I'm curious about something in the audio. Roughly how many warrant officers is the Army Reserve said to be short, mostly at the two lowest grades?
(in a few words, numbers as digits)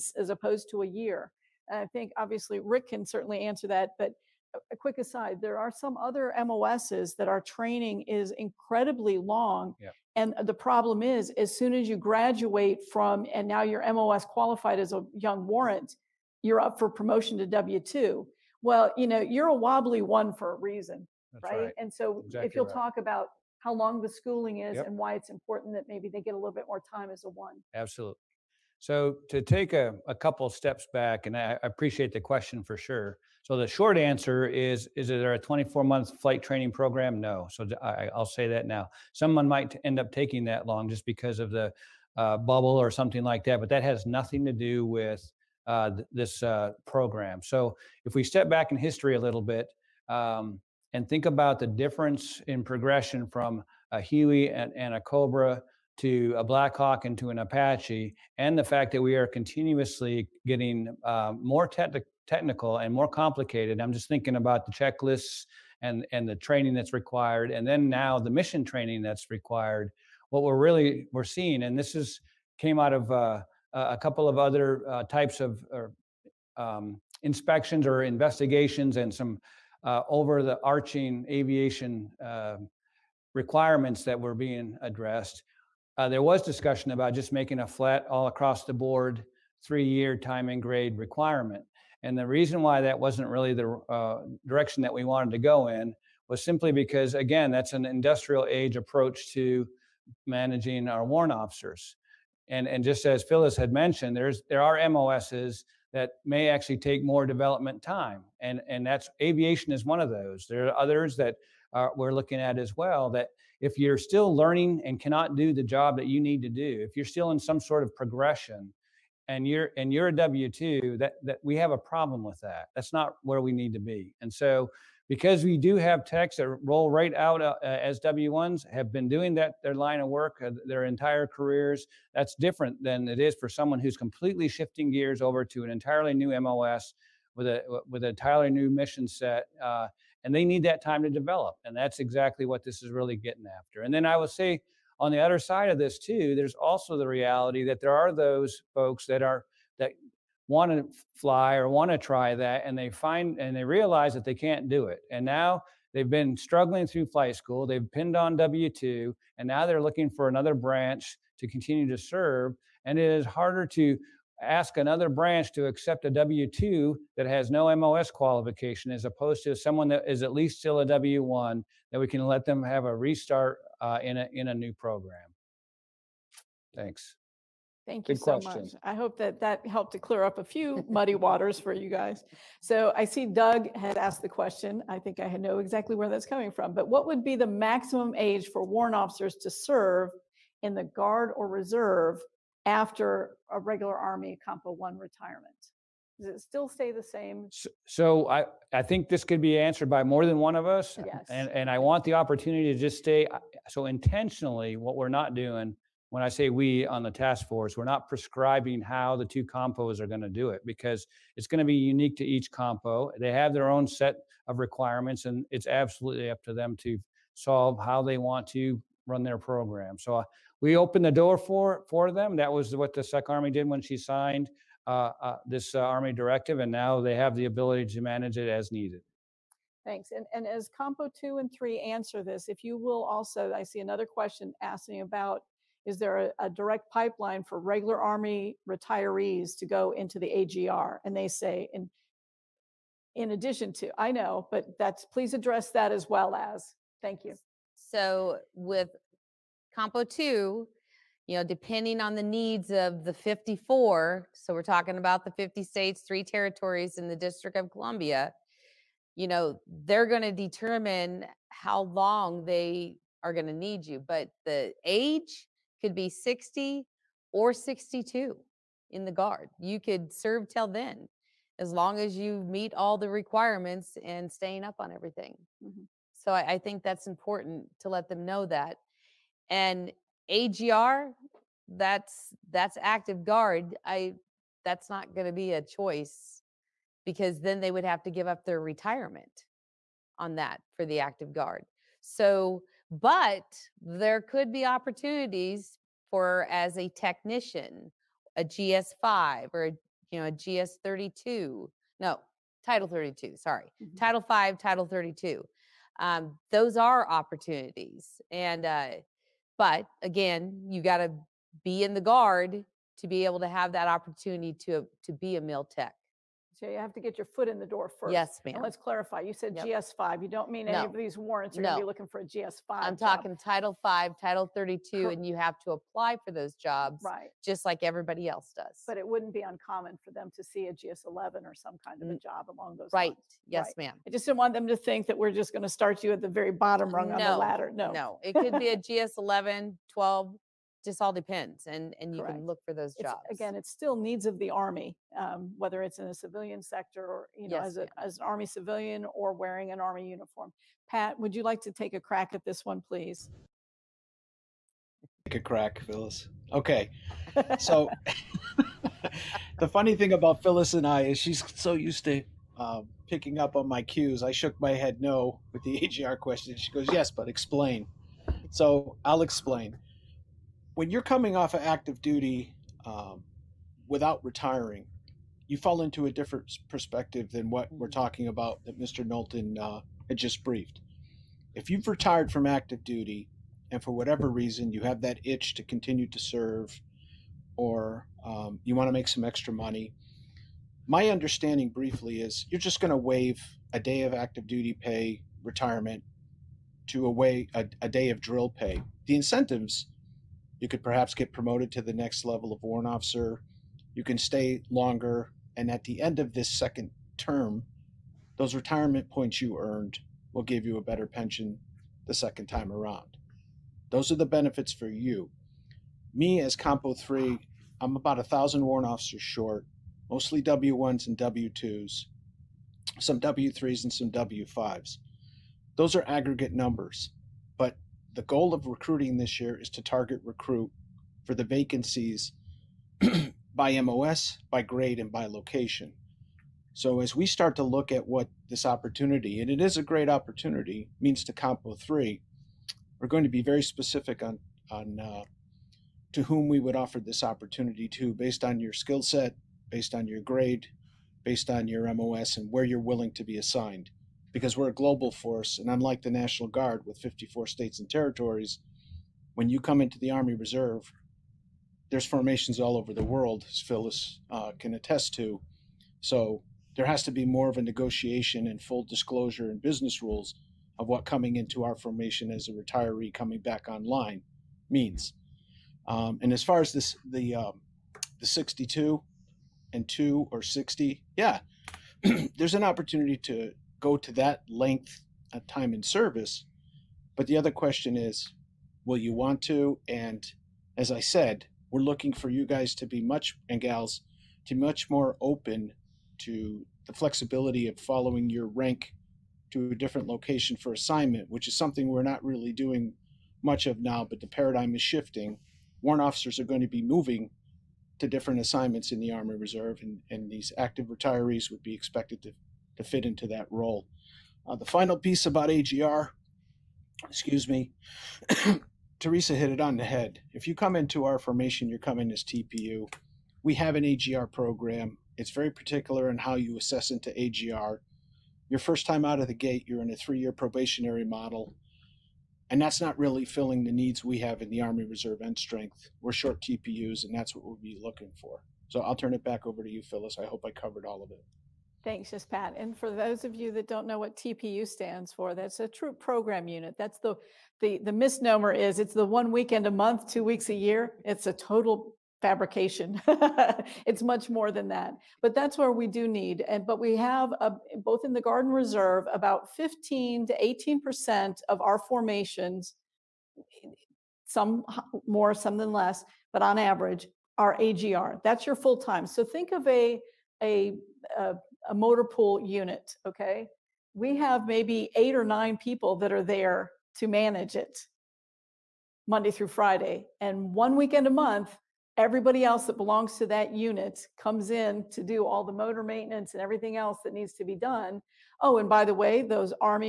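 a thousand.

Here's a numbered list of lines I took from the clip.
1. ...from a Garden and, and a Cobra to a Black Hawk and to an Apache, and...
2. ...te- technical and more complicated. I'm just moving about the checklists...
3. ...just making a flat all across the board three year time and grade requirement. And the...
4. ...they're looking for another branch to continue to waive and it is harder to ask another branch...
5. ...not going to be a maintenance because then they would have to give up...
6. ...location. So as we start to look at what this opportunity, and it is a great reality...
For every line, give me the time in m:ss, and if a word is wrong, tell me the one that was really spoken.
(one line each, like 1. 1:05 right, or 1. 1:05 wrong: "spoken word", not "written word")
1. 0:53 wrong: "Huey", not "Garden"
2. 1:01 wrong: "thinking", not "moving"
3. 1:27 right
4. 2:39 wrong: "serve", not "waive"
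5. 4:44 wrong: "choice", not "maintenance"
6. 7:15 wrong: "opportunity", not "reality".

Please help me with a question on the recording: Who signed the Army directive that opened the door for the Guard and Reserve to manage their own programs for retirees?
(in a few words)
SEC Army.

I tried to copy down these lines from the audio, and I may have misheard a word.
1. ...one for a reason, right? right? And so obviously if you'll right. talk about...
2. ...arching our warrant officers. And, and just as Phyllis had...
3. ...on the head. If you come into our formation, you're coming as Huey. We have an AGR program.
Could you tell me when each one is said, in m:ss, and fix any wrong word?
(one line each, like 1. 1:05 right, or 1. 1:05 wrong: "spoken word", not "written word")
1. 0:20 wrong: "exactly", not "obviously"
2. 1:40 wrong: "managing", not "arching"
3. 8:39 wrong: "TPU", not "Huey".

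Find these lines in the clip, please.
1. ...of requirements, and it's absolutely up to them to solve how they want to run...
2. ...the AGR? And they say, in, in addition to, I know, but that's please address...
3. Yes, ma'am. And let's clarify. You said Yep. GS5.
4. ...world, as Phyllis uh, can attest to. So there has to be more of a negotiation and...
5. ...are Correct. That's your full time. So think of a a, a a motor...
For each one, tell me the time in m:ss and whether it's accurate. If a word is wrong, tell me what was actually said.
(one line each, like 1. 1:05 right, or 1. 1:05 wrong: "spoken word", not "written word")
1. 3:34 right
2. 4:00 right
3. 5:18 right
4. 7:43 right
5. 9:27 wrong: "AGR", not "Correct".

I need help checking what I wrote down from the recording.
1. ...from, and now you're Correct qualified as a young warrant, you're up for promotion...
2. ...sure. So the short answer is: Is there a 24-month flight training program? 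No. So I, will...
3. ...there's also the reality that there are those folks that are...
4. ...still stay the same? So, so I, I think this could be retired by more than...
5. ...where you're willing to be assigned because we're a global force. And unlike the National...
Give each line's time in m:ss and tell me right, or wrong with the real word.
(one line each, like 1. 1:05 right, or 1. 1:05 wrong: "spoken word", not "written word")
1. 0:12 wrong: "MOS", not "Correct"
2. 0:32 right
3. 2:26 right
4. 3:16 wrong: "answered", not "retired"
5. 7:32 right.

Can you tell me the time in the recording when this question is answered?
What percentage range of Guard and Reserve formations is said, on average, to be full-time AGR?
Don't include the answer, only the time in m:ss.
9:19.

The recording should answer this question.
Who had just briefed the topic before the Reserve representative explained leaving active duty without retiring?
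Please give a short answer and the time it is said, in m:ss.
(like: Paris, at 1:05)
Mr. Knowlton, at 6:18.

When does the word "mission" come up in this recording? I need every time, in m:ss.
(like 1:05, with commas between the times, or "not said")
1:08, 2:18.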